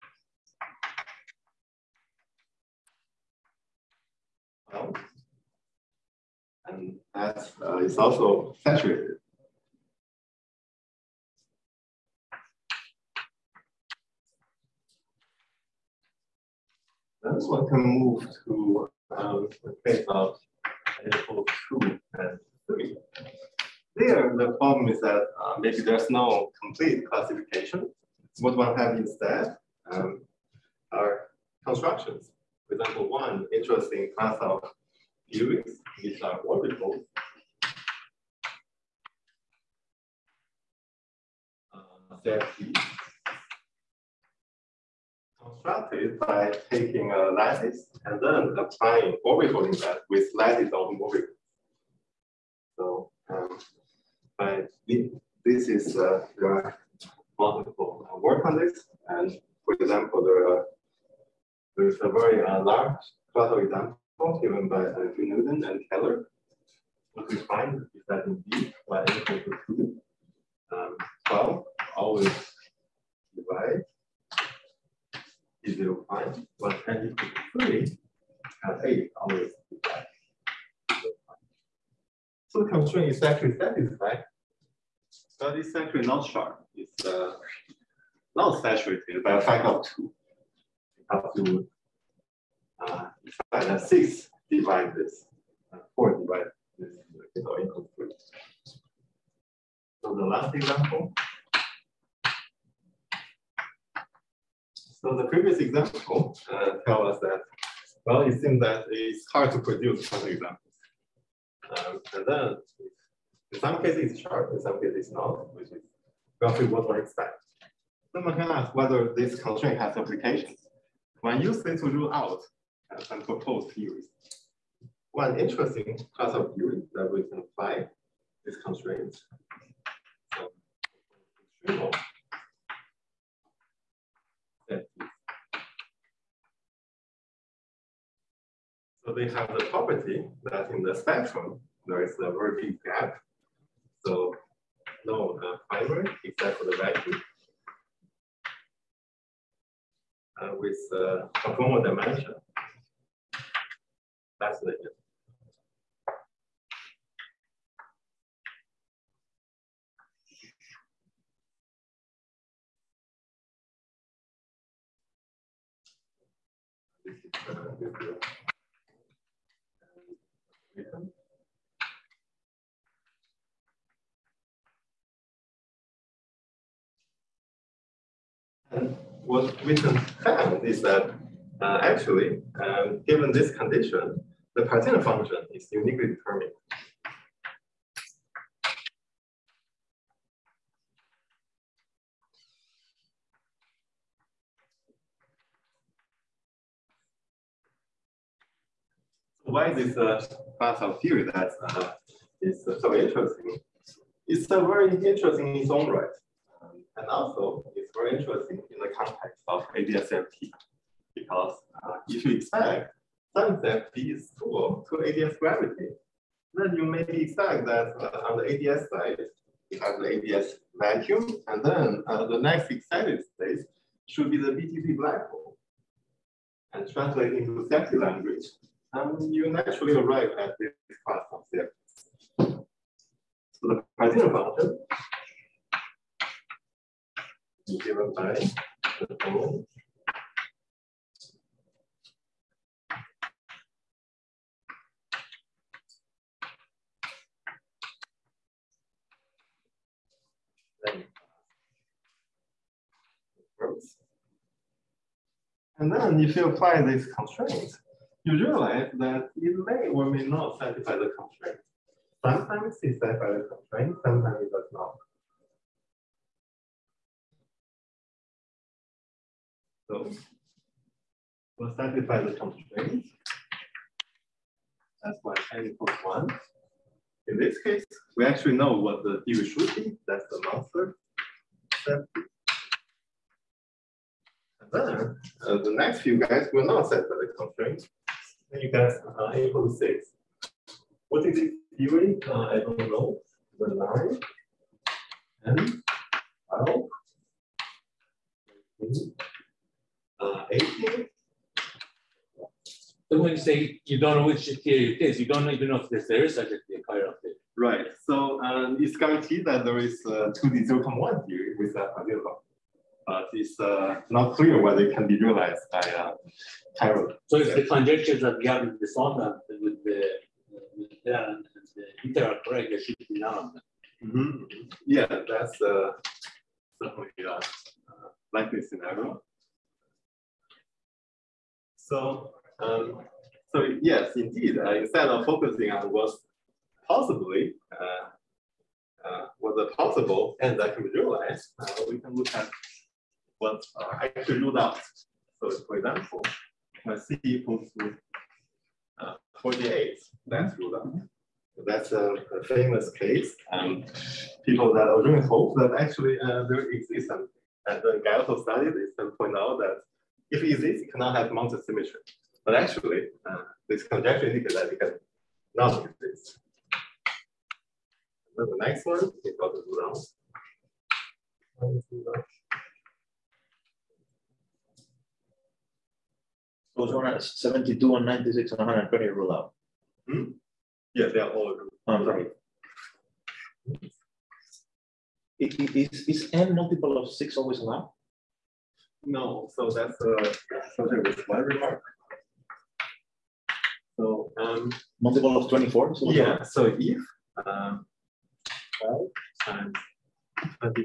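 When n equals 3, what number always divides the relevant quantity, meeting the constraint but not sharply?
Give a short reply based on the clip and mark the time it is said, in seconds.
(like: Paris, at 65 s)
8, at 78 s.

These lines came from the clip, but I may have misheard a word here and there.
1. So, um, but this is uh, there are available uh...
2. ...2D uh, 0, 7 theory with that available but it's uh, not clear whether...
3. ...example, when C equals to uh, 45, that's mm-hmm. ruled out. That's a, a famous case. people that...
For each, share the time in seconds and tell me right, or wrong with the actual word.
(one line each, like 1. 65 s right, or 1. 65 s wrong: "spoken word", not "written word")
1. 52 s wrong: "multiple", not "available"
2. 310 s wrong: "1", not "7"
3. 345 s wrong: "48", not "45".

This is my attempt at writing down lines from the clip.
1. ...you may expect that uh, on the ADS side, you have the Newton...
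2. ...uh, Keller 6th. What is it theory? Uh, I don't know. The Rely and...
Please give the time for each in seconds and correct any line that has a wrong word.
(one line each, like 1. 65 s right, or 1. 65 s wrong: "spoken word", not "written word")
1. 216 s wrong: "ADS", not "Newton"
2. 289 s wrong: "April", not "Keller".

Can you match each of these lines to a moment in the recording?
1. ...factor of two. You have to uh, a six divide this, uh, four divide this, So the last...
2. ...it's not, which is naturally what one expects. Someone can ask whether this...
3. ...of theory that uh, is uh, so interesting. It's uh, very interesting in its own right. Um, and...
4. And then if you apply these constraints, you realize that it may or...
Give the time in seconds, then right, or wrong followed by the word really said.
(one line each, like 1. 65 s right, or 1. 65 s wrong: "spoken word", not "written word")
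1. 89 s right
2. 114 s wrong: "roughly", not "naturally"
3. 200 s right
4. 255 s right.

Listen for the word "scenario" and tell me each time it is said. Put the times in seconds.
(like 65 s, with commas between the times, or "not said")
328 s.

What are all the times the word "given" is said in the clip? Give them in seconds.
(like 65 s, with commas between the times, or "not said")
64 s, 183 s, 237 s.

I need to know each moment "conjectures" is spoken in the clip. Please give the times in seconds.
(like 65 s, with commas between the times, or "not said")
317 s, 363 s.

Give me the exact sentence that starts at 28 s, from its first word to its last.
What one have instead um, are constructions.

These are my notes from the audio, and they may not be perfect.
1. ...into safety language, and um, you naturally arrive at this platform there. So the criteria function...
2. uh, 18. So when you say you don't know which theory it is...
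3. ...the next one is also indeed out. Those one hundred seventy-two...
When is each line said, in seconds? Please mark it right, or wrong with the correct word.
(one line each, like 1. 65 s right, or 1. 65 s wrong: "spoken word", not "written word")
1. 227 s right
2. 300 s right
3. 368 s wrong: "ruled", not "indeed".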